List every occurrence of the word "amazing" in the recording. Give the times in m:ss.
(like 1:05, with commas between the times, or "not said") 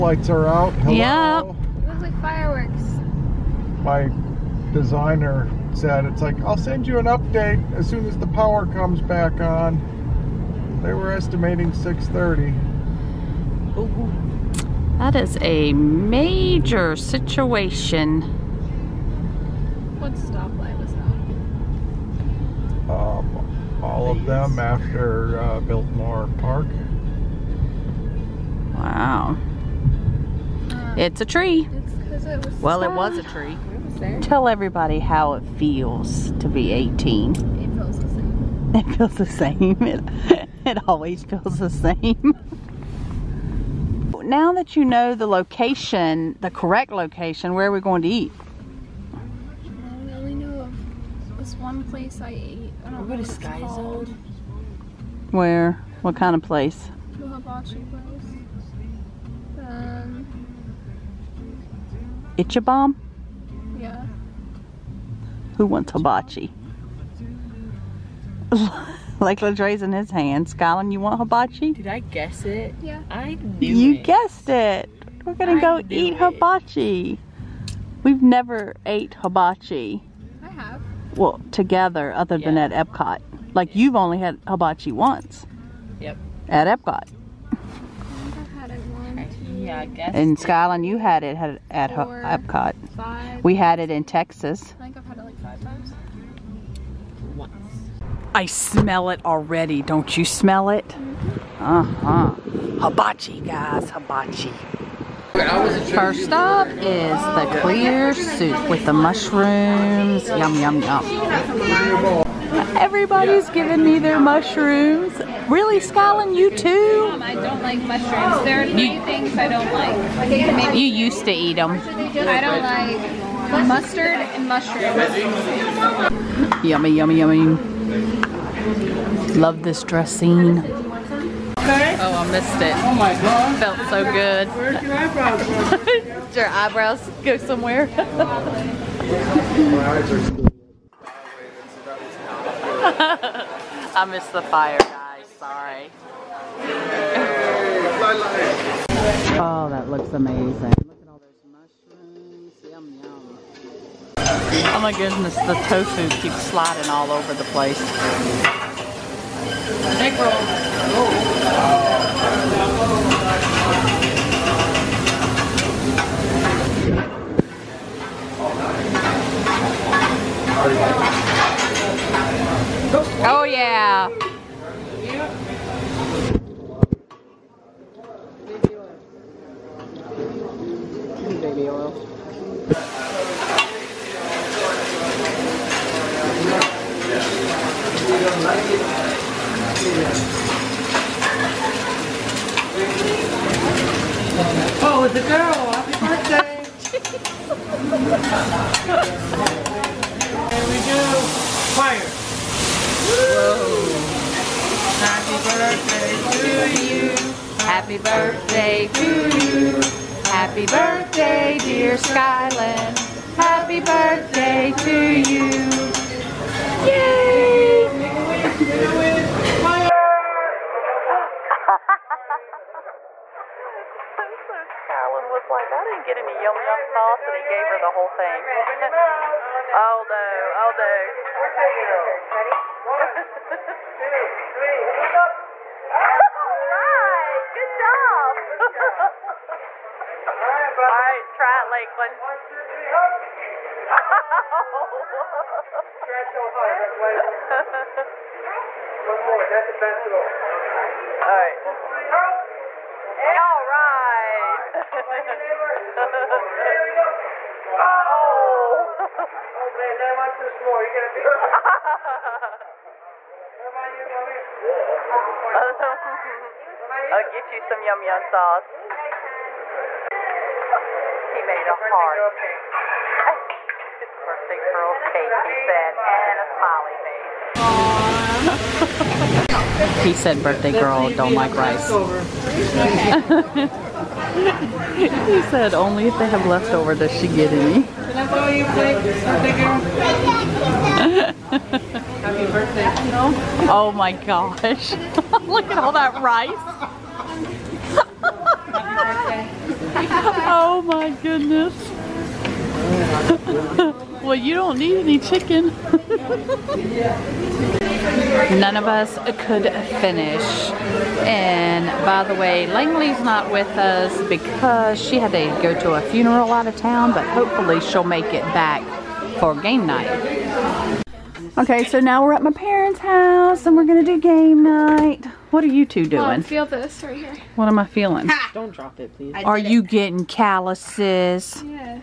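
2:30.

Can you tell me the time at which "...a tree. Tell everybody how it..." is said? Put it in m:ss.
0:33.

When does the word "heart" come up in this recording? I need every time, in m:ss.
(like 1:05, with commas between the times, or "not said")
4:06, 4:31.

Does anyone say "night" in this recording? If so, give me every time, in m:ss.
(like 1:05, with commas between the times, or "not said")
5:19, 5:24.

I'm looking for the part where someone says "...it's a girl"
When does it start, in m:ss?
3:15.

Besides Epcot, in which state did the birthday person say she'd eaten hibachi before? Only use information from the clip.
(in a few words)
Texas.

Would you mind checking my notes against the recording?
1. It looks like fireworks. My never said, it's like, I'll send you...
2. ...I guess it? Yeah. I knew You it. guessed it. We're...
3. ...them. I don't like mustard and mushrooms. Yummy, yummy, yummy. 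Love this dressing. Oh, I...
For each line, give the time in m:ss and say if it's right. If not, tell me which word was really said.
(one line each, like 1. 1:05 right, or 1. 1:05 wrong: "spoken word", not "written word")
1. 0:01 wrong: "designer", not "never"
2. 1:11 right
3. 2:01 right.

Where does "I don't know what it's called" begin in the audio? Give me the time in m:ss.
0:52.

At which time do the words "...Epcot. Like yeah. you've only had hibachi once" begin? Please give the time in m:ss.
1:22.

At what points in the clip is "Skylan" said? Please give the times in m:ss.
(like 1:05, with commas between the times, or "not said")
1:10, 1:30, 1:55, 3:31.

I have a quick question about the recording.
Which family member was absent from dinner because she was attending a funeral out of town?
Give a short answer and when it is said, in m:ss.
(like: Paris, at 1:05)
Langley, at 5:12.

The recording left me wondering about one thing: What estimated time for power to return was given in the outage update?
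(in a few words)
6:30.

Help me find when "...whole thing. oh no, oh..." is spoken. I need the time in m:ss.
3:47.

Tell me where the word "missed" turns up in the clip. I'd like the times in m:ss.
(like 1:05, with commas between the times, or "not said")
2:12, 2:24.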